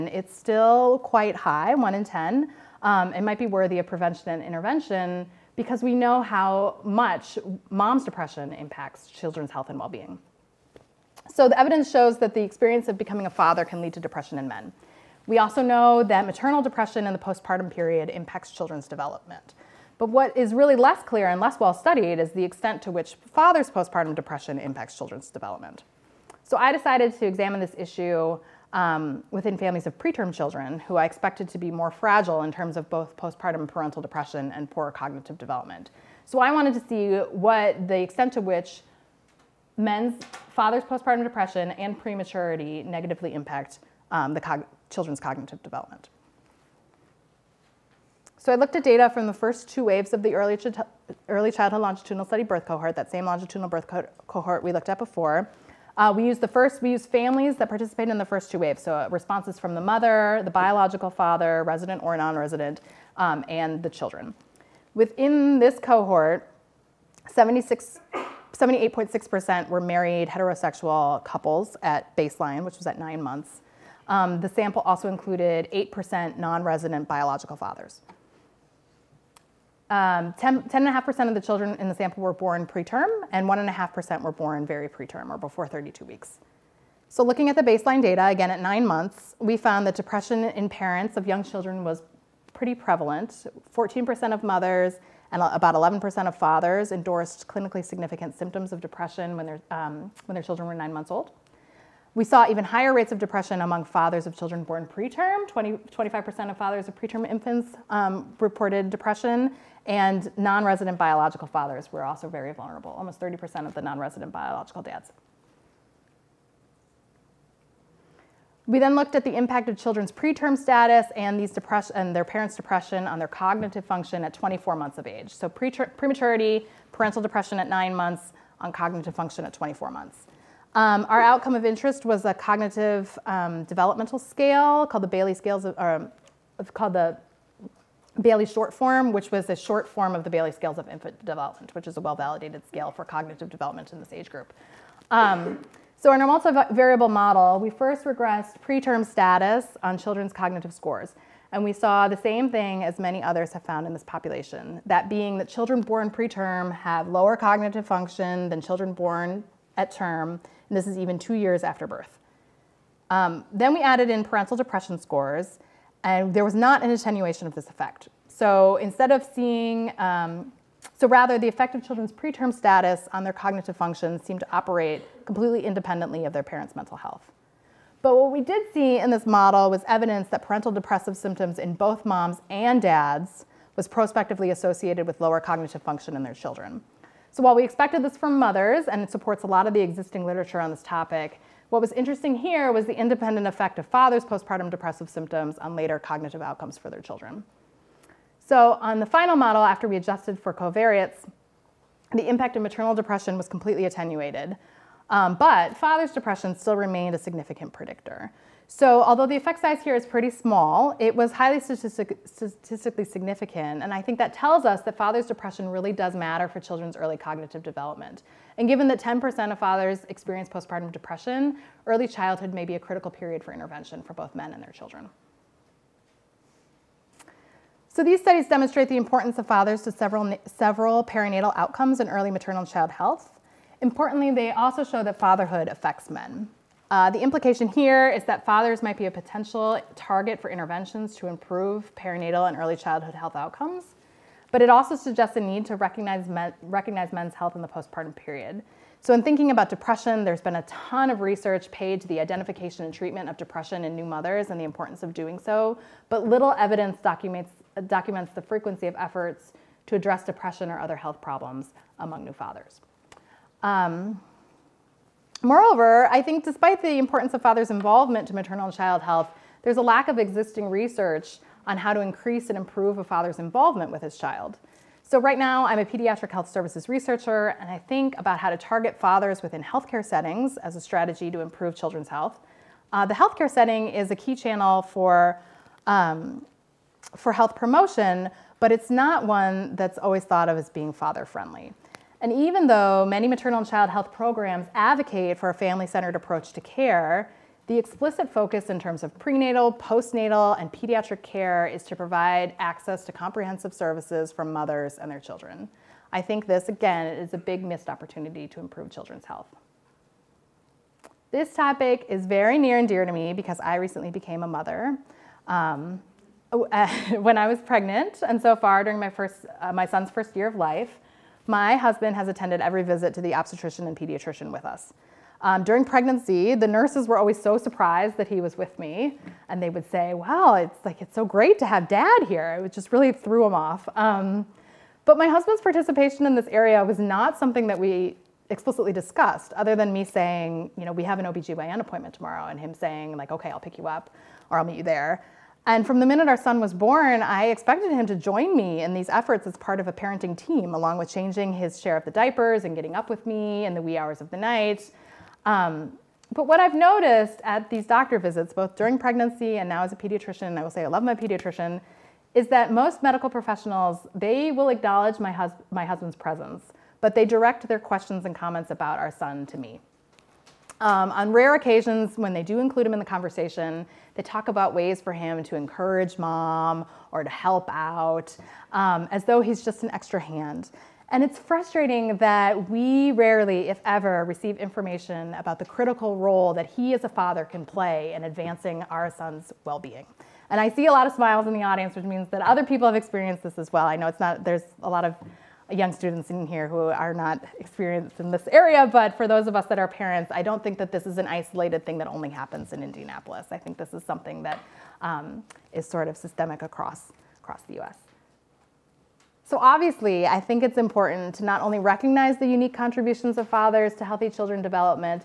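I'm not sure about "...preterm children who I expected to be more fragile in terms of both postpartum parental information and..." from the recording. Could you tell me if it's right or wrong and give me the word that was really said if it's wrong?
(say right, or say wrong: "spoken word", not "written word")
wrong: "depression", not "information".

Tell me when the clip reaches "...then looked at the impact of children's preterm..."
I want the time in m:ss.
1:58.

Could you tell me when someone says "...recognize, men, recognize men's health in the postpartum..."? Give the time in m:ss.
4:05.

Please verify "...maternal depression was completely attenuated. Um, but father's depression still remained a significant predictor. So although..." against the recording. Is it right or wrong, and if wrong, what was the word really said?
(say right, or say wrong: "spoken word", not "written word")
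right.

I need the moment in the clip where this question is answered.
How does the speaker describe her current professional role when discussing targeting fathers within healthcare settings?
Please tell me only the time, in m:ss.
4:35.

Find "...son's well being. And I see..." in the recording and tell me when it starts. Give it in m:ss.
6:29.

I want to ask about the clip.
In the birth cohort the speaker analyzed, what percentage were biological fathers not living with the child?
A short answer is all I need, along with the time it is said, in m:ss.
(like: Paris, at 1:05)
8%, at 1:15.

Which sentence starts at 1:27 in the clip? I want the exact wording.
So looking at the baseline data, again at nine months, we found that depression in parents of young children was pretty prevalent.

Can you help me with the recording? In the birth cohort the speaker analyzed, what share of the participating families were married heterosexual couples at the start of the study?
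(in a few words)
78.6%.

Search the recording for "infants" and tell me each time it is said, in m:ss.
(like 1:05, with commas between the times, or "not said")
1:47, 2:20.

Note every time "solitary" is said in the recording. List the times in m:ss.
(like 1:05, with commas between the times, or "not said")
not said.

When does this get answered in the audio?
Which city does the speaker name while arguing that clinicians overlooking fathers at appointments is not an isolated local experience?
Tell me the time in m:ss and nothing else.
6:42.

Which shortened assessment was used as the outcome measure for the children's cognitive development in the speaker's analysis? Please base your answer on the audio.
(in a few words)
Bayley short form.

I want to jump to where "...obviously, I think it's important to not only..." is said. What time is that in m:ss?
6:49.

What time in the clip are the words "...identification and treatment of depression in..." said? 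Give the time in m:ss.
4:12.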